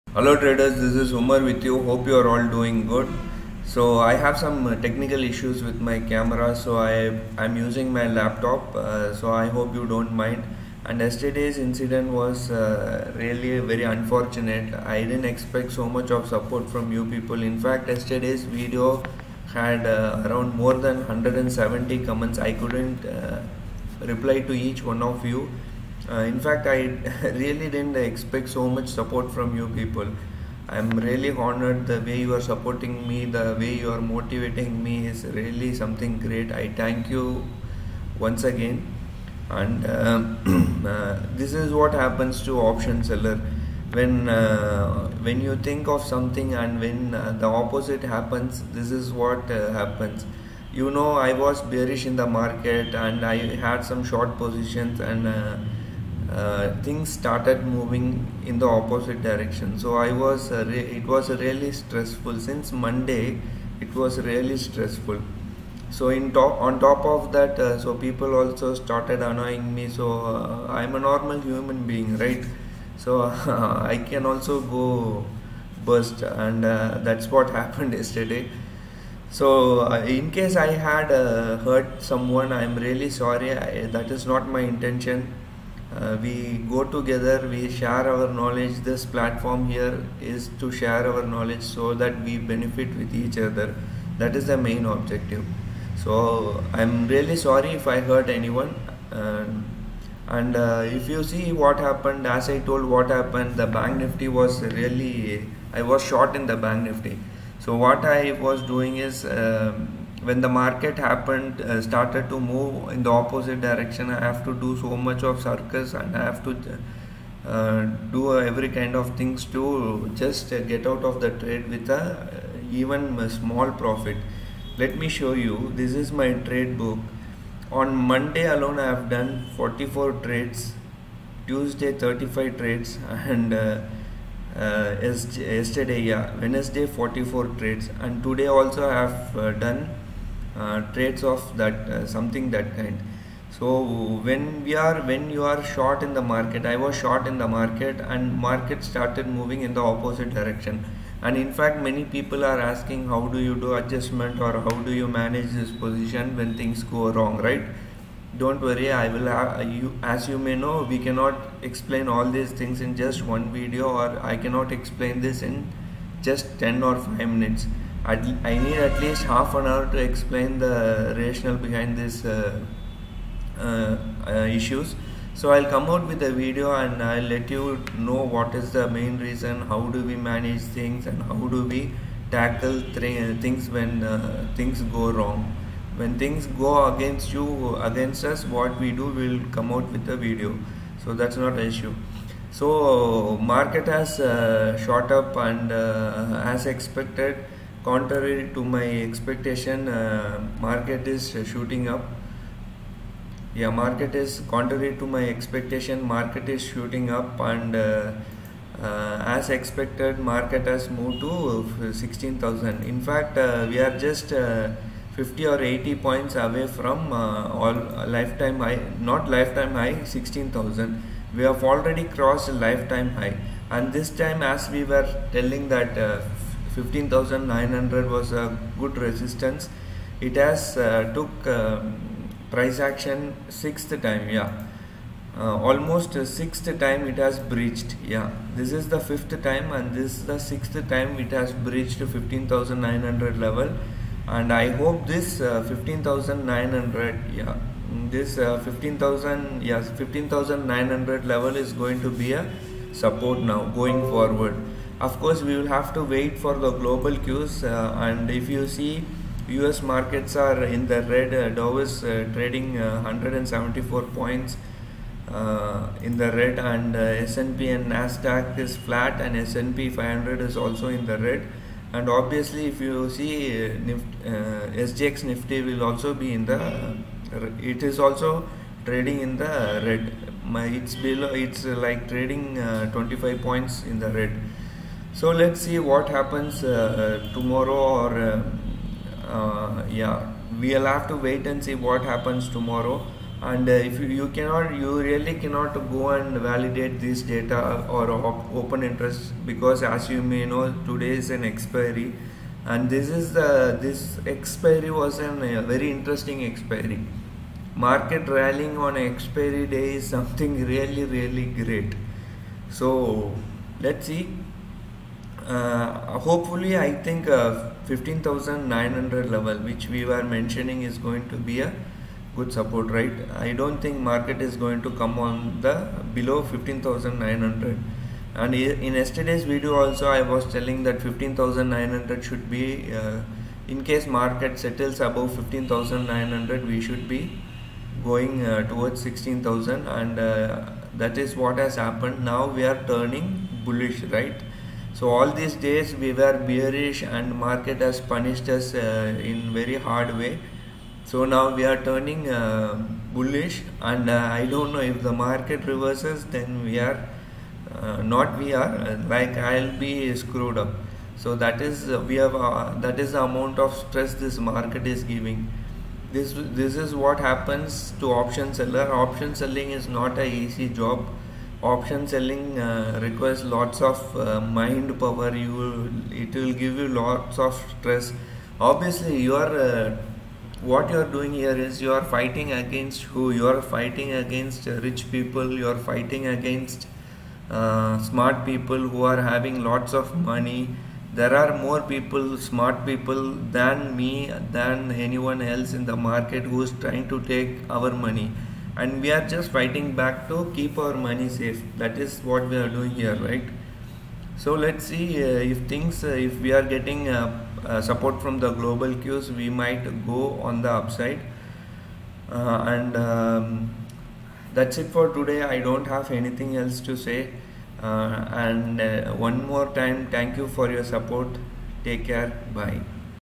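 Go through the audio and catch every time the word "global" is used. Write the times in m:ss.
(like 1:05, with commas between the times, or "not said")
4:16, 6:48.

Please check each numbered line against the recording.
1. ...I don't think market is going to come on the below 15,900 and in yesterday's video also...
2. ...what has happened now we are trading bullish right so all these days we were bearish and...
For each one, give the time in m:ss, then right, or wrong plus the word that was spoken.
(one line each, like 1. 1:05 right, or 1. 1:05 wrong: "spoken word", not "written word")
1. 5:23 right
2. 5:41 wrong: "turning", not "trading".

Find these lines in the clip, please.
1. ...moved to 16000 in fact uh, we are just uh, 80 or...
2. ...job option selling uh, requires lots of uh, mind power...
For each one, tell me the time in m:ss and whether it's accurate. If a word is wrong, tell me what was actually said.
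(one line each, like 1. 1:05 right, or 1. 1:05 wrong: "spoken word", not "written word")
1. 3:30 wrong: "50", not "80"
2. 6:10 right.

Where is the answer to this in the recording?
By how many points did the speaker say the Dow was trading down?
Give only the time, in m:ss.
4:22.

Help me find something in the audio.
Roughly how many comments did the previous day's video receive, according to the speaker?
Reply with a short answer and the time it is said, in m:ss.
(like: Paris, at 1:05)
more than 170, at 0:20.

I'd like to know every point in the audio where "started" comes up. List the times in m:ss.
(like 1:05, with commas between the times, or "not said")
0:57, 1:08, 1:51, 2:28.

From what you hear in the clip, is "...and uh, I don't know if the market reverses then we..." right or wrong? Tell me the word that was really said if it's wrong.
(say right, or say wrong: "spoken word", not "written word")
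right.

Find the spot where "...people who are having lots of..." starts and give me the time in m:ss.
6:28.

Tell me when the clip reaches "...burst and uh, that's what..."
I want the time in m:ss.
1:15.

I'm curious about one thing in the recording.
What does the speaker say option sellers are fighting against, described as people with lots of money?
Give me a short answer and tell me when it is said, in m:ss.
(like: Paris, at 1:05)
rich people, at 6:24.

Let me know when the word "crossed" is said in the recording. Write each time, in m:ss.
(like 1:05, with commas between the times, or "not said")
3:42.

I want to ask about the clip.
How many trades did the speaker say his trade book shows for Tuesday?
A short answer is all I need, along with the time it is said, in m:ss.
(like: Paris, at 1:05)
35, at 2:12.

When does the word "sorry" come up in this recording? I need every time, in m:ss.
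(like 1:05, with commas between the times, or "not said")
1:23, 1:37.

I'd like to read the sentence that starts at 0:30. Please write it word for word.
I'm really honored the way you are supporting me, the way you are motivating me is really something great.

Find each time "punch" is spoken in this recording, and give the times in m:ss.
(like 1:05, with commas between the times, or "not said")
not said.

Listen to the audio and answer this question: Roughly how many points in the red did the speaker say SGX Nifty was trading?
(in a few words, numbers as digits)
25.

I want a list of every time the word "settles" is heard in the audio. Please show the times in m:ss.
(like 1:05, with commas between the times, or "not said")
5:34.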